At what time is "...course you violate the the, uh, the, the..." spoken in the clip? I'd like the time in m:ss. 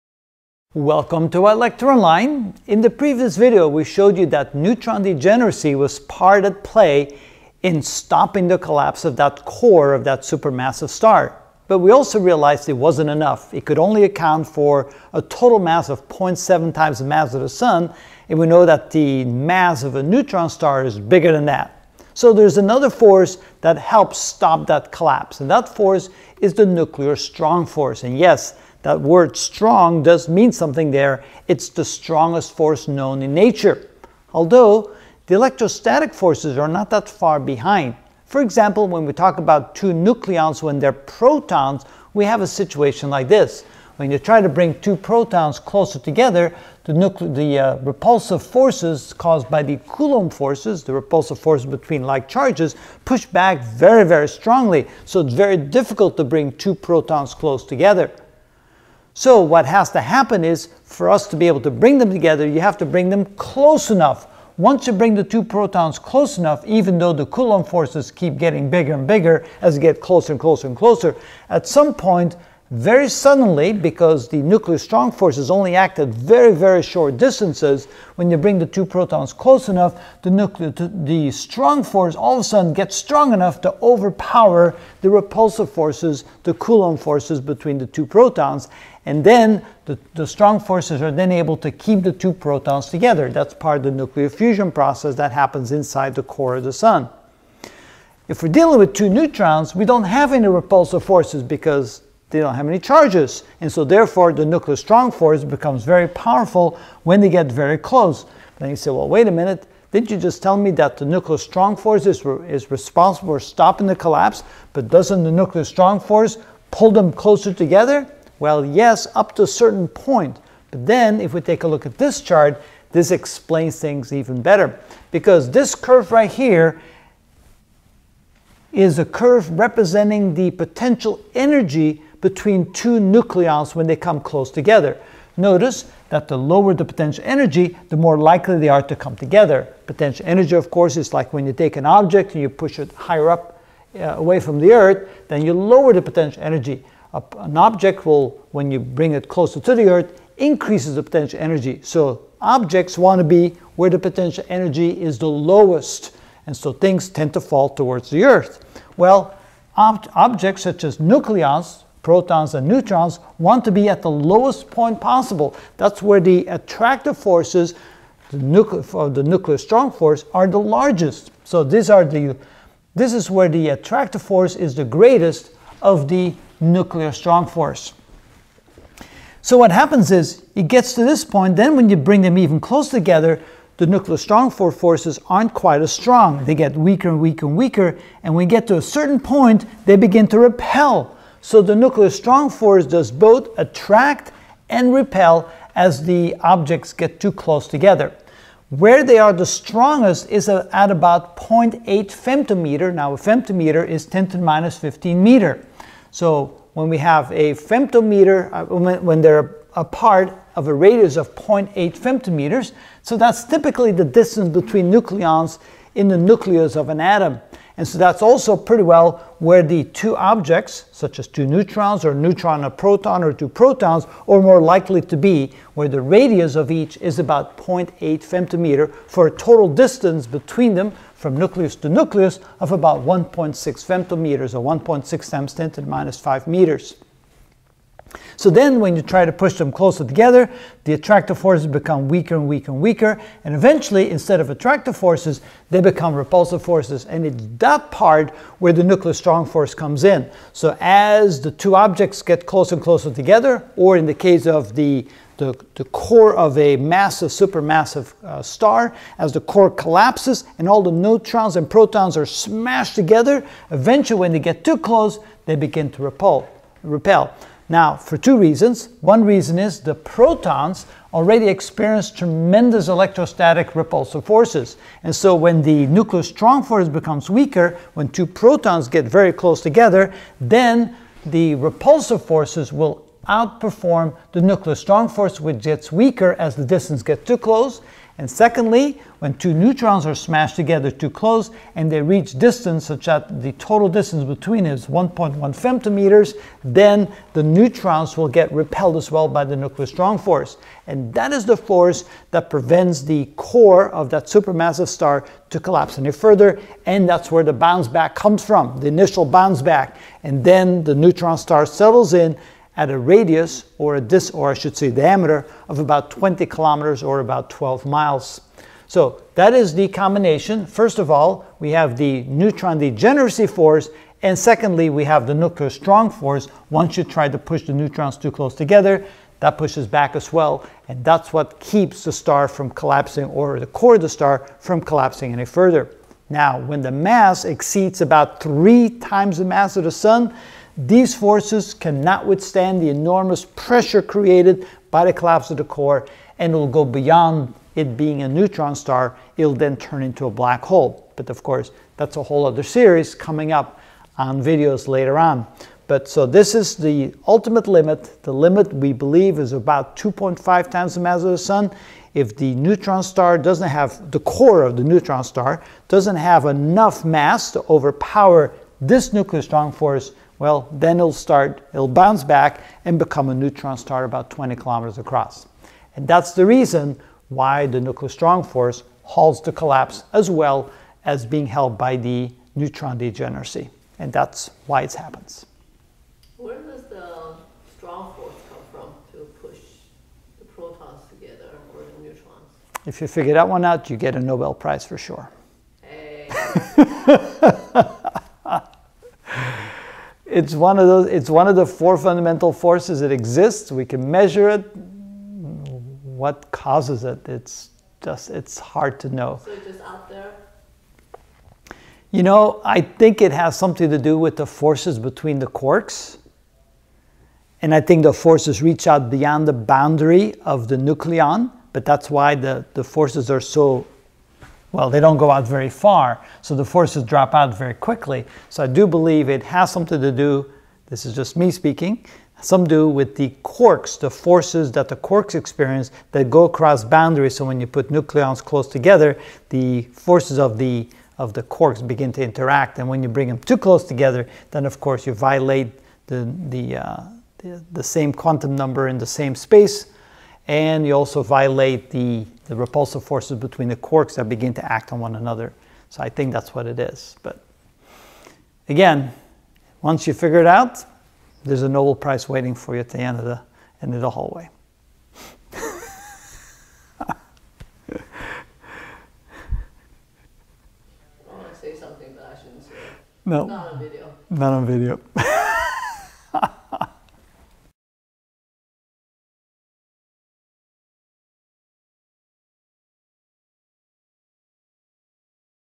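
7:24.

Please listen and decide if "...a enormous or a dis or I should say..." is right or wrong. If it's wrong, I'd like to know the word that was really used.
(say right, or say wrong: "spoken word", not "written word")
wrong: "radius", not "enormous".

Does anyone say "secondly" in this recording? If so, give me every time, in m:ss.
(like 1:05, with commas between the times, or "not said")
4:48, 5:24.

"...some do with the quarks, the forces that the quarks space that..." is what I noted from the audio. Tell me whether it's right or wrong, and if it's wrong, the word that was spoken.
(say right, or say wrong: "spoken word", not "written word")
wrong: "experience", not "space".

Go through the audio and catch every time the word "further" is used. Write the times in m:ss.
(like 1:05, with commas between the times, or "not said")
5:06, 5:35.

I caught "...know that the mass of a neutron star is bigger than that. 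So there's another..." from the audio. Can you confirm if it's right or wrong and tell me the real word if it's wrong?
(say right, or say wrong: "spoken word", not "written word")
right.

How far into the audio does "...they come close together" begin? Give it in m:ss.
2:13.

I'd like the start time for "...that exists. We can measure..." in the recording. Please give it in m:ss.
6:43.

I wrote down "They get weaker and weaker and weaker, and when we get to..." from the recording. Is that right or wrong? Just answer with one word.
right.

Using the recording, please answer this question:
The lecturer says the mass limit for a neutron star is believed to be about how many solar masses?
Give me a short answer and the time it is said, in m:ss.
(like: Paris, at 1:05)
2.5, at 5:59.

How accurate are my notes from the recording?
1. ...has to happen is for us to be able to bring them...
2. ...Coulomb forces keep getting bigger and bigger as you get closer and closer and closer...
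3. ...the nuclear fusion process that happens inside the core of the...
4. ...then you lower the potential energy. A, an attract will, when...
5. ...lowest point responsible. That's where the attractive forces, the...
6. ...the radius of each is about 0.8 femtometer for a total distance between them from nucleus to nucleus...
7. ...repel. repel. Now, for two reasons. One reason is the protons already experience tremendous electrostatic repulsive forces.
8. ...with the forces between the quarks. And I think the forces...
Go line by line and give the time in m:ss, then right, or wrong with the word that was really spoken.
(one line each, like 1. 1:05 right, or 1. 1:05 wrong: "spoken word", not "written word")
1. 0:59 right
2. 1:07 right
3. 1:33 right
4. 2:25 wrong: "object", not "attract"
5. 2:44 wrong: "possible", not "responsible"
6. 3:45 right
7. 4:26 right
8. 6:54 right.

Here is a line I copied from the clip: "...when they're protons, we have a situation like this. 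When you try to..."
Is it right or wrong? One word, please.
right.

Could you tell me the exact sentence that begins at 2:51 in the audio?
So these are the, this is where the attractive force is the greatest of the nuclear strong force.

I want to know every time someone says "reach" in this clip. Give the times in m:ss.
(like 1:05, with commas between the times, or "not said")
4:52, 6:58.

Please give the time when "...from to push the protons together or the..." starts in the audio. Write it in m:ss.
6:28.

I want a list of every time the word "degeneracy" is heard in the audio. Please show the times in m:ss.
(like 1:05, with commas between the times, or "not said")
0:05, 5:22, 6:22.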